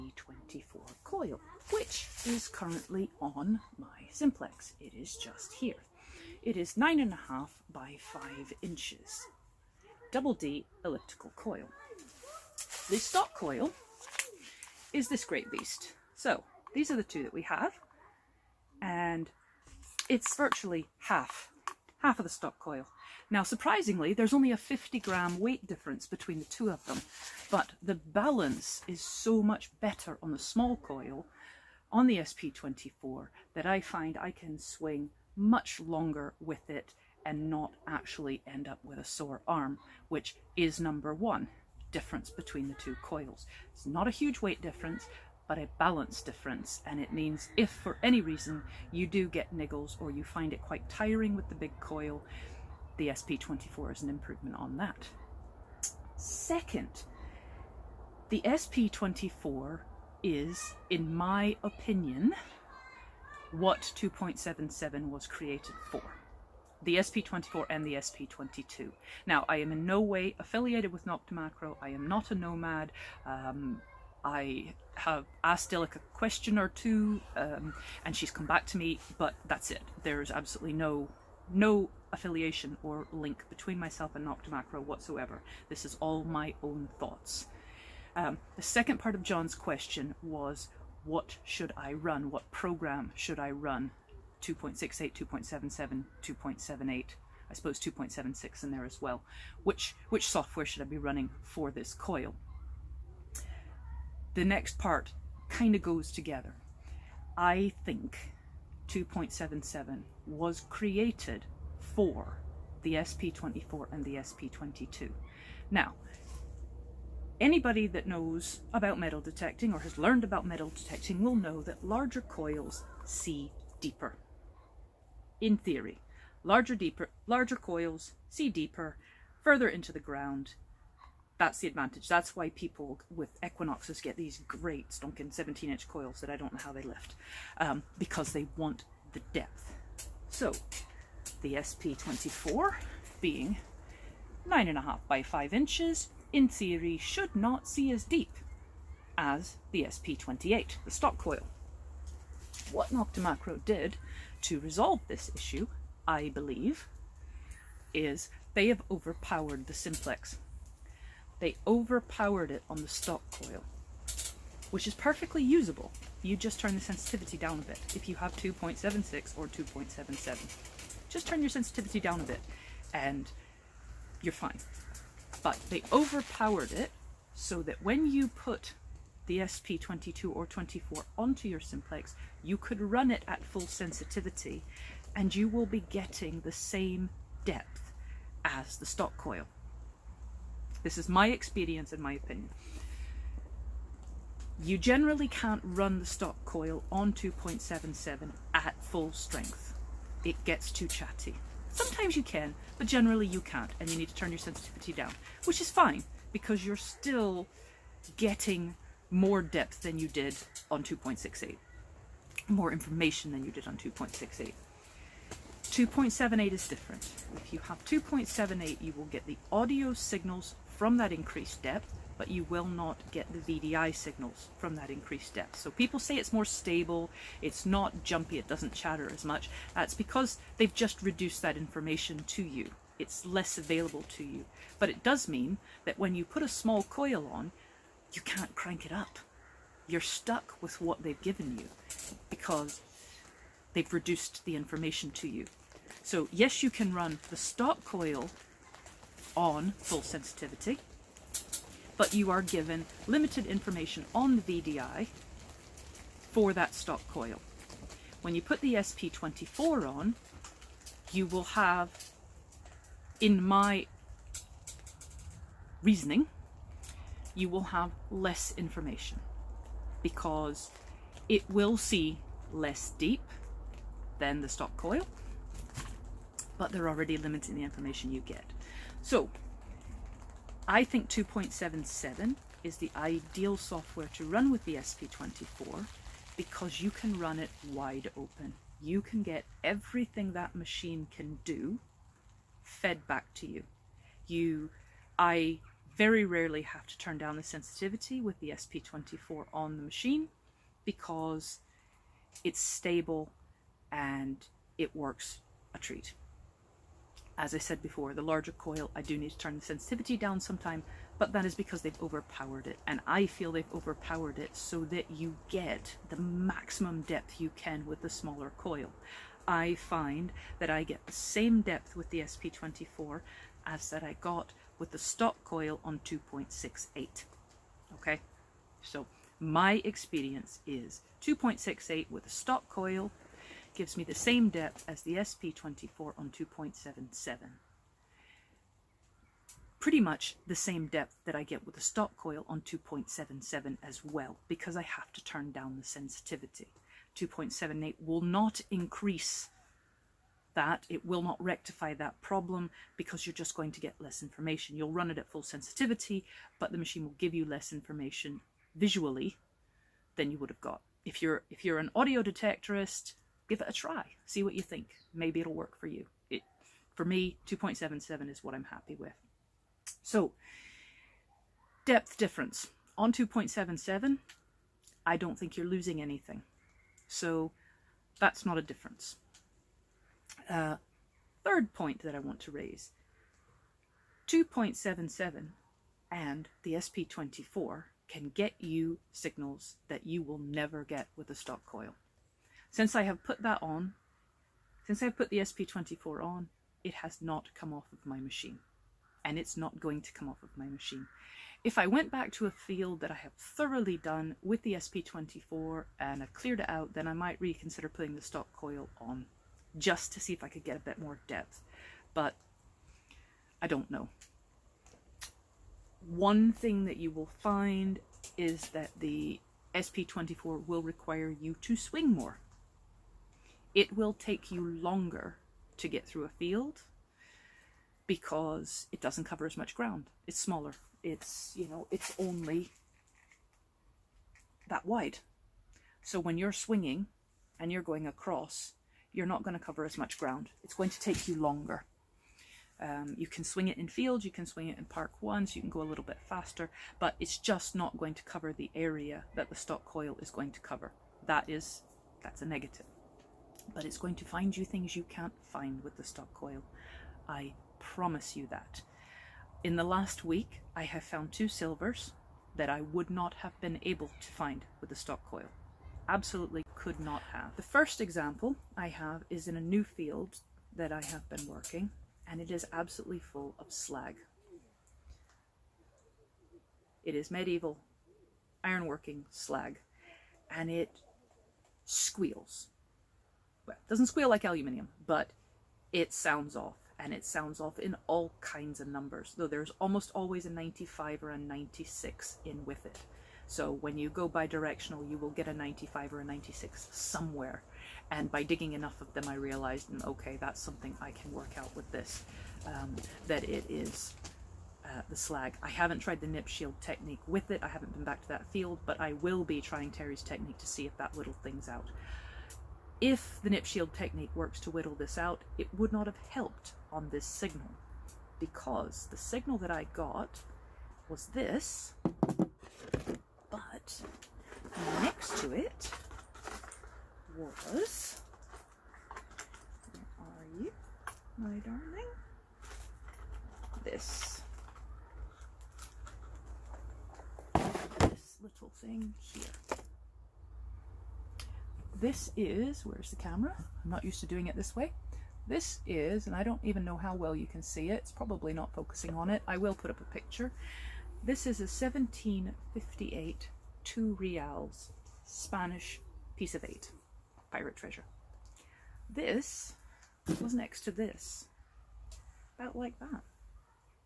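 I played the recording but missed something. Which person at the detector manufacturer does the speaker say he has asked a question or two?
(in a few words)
Dilek.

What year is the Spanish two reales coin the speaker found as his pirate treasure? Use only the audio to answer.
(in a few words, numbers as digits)
1758.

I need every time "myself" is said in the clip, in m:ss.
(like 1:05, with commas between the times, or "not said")
1:23.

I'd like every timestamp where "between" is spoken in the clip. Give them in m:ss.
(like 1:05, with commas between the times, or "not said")
0:26, 0:42, 1:23.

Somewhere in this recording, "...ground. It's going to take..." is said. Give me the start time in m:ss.
7:20.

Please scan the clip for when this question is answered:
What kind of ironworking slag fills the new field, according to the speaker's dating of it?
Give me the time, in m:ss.
7:57.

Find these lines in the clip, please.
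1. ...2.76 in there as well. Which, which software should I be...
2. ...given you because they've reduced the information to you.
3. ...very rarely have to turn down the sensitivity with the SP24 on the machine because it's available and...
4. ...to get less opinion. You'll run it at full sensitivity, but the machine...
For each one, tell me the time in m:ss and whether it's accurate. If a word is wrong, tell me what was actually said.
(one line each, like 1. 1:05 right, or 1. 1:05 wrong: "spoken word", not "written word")
1. 1:37 right
2. 4:01 right
3. 4:55 wrong: "stable", not "available"
4. 5:53 wrong: "information", not "opinion".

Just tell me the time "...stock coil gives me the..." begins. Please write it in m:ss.
5:32.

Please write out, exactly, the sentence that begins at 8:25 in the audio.
I haven't tried the nip shield technique with it.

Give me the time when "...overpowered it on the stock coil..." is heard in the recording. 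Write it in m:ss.
2:41.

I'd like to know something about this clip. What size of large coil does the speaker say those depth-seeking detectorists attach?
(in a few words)
17 inch.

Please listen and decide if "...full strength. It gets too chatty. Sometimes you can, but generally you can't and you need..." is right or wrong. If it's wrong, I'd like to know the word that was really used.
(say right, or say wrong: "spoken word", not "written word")
right.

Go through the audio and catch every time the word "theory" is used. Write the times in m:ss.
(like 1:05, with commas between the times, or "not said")
2:05, 2:26.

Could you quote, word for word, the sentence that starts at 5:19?
I find that I get the same depth with the SP24 as that I got with the stock coil on 2.68.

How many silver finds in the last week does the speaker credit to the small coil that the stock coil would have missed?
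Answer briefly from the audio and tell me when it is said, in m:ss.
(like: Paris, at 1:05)
2, at 7:41.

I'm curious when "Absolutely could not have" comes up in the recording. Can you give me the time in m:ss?
7:46.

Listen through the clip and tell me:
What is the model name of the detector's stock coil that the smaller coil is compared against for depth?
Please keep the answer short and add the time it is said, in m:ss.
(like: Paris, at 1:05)
SP28, at 2:29.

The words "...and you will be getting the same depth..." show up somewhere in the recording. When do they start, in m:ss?
3:05.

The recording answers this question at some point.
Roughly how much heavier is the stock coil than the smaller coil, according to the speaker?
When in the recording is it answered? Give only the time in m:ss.
0:24.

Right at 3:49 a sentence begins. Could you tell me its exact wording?
That's because they've just reduced that information to you.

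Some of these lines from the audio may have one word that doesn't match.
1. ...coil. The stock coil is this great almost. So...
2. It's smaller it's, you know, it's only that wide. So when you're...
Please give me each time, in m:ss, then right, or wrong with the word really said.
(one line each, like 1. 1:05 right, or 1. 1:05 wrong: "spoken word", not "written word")
1. 0:11 wrong: "beast", not "almost"
2. 7:10 right.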